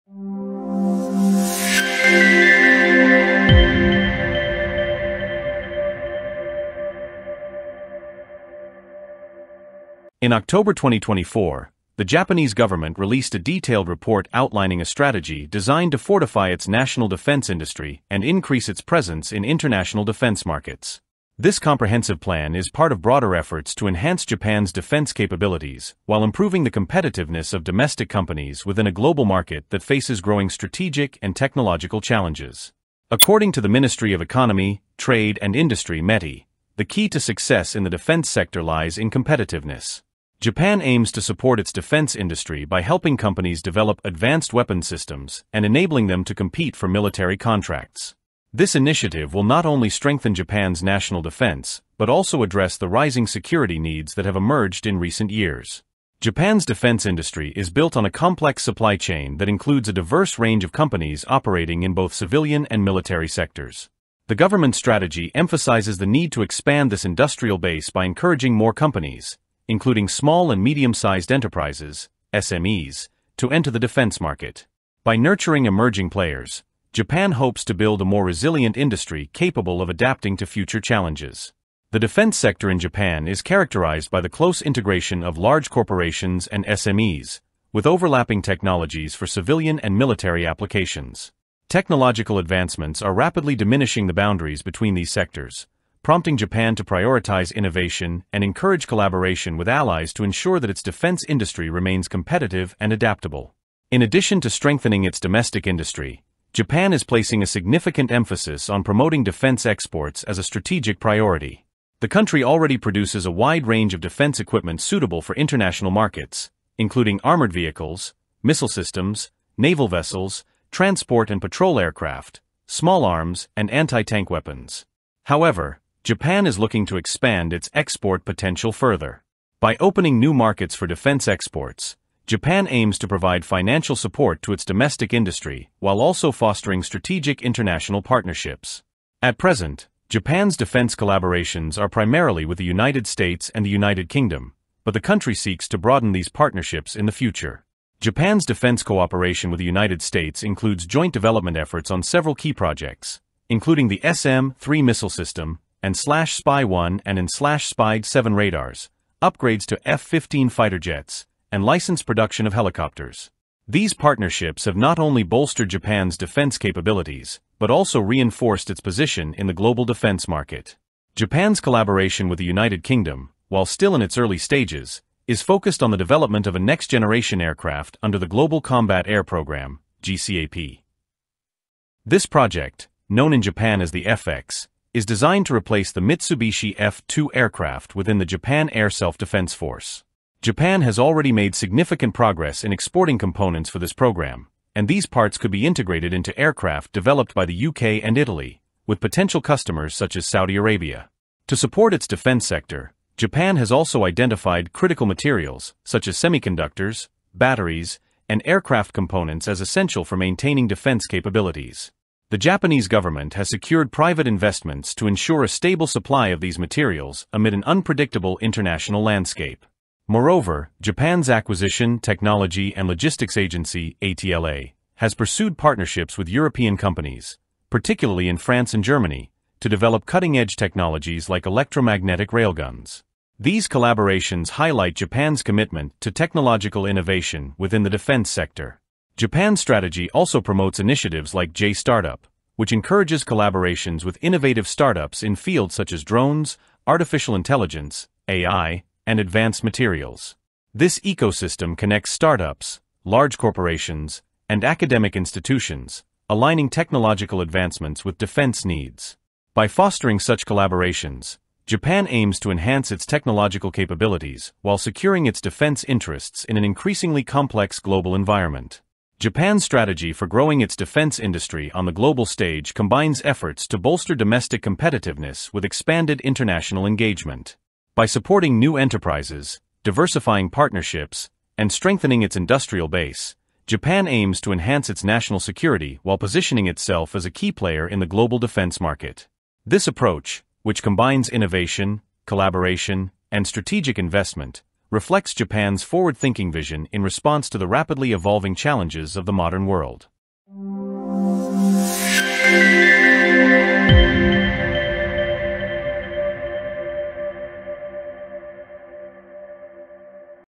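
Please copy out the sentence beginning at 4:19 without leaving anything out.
By fostering such collaborations, Japan aims to enhance its technological capabilities while securing its defense interests in an increasingly complex global environment.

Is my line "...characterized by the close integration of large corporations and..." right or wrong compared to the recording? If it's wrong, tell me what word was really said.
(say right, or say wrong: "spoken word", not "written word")
right.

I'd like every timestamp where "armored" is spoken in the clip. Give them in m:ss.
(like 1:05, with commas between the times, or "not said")
1:57.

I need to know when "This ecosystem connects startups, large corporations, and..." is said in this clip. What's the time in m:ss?
4:10.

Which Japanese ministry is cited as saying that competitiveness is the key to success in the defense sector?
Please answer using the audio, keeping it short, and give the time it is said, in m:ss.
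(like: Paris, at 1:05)
Ministry of Economy, Trade and Industry, at 0:33.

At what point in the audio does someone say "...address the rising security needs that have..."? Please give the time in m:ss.
0:52.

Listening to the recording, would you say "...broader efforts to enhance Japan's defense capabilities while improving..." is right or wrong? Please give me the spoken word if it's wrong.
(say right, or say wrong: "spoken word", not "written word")
right.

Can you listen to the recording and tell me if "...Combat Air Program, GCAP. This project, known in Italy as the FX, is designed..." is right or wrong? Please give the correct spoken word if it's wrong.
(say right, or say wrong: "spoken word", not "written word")
wrong: "Japan", not "Italy".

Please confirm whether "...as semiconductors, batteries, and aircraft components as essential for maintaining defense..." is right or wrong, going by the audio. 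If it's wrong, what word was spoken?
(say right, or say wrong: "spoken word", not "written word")
right.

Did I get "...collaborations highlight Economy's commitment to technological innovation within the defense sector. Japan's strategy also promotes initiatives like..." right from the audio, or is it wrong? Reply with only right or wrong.
wrong.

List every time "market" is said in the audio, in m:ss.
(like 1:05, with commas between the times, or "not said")
0:20, 0:29, 1:14, 1:55, 2:10, 2:50, 4:48.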